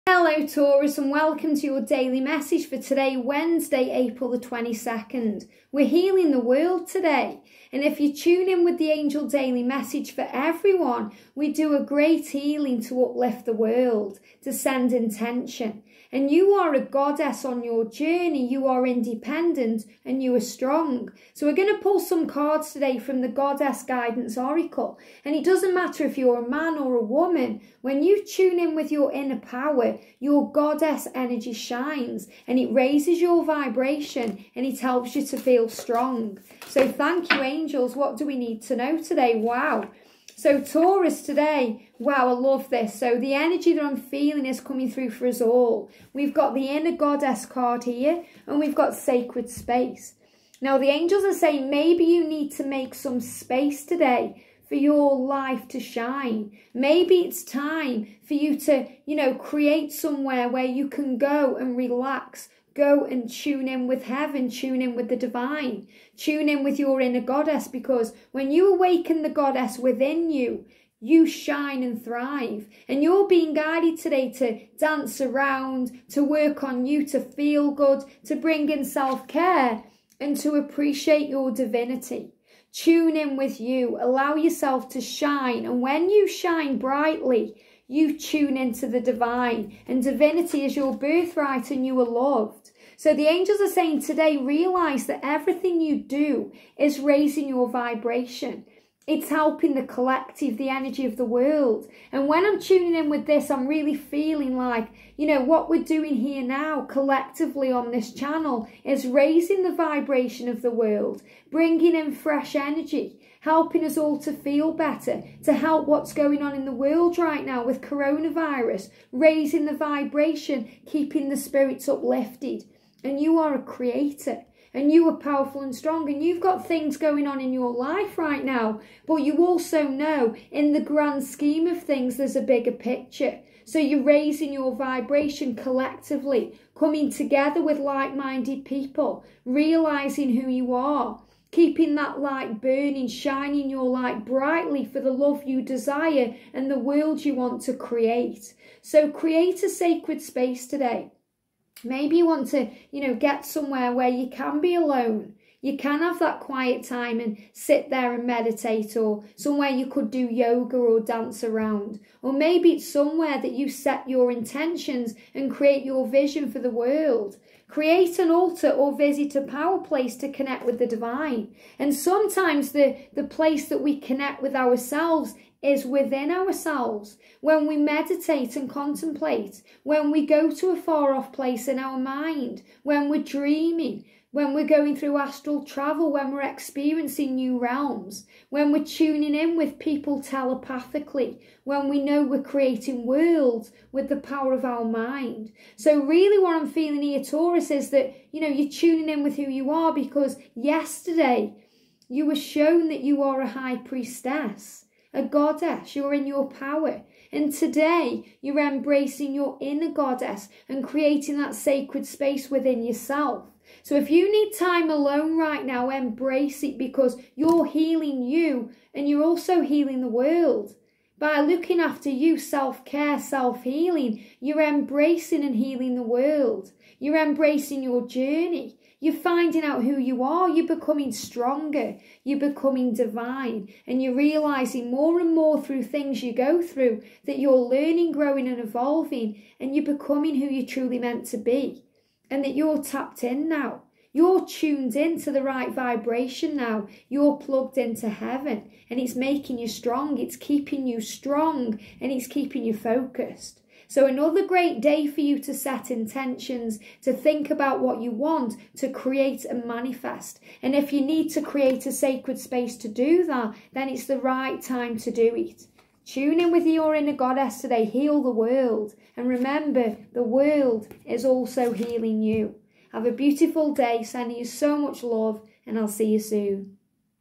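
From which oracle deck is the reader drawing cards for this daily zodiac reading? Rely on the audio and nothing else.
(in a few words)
Goddess Guidance Oracle.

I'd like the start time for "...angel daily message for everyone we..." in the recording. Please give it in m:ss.
0:08.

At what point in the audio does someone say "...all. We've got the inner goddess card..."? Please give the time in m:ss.
0:45.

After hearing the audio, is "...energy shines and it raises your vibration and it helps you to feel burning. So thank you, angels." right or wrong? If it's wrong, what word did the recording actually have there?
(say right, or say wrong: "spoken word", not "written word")
wrong: "strong", not "burning".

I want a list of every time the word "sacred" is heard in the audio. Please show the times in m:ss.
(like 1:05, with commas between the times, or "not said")
0:48, 2:29, 3:31, 4:21.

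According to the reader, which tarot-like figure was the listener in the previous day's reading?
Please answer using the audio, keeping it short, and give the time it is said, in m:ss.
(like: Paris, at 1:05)
High priestess, at 3:23.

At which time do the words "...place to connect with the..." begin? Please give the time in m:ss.
2:49.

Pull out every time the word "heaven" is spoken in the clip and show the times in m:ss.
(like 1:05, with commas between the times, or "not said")
1:04, 4:08.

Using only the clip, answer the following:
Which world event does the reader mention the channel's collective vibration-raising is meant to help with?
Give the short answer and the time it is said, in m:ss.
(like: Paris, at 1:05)
Coronavirus, at 1:57.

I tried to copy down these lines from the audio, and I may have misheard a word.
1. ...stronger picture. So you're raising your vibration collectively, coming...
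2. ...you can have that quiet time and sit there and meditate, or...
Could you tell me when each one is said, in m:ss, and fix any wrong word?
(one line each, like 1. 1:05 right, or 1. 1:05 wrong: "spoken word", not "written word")
1. 2:12 wrong: "bigger", not "stronger"
2. 2:35 right.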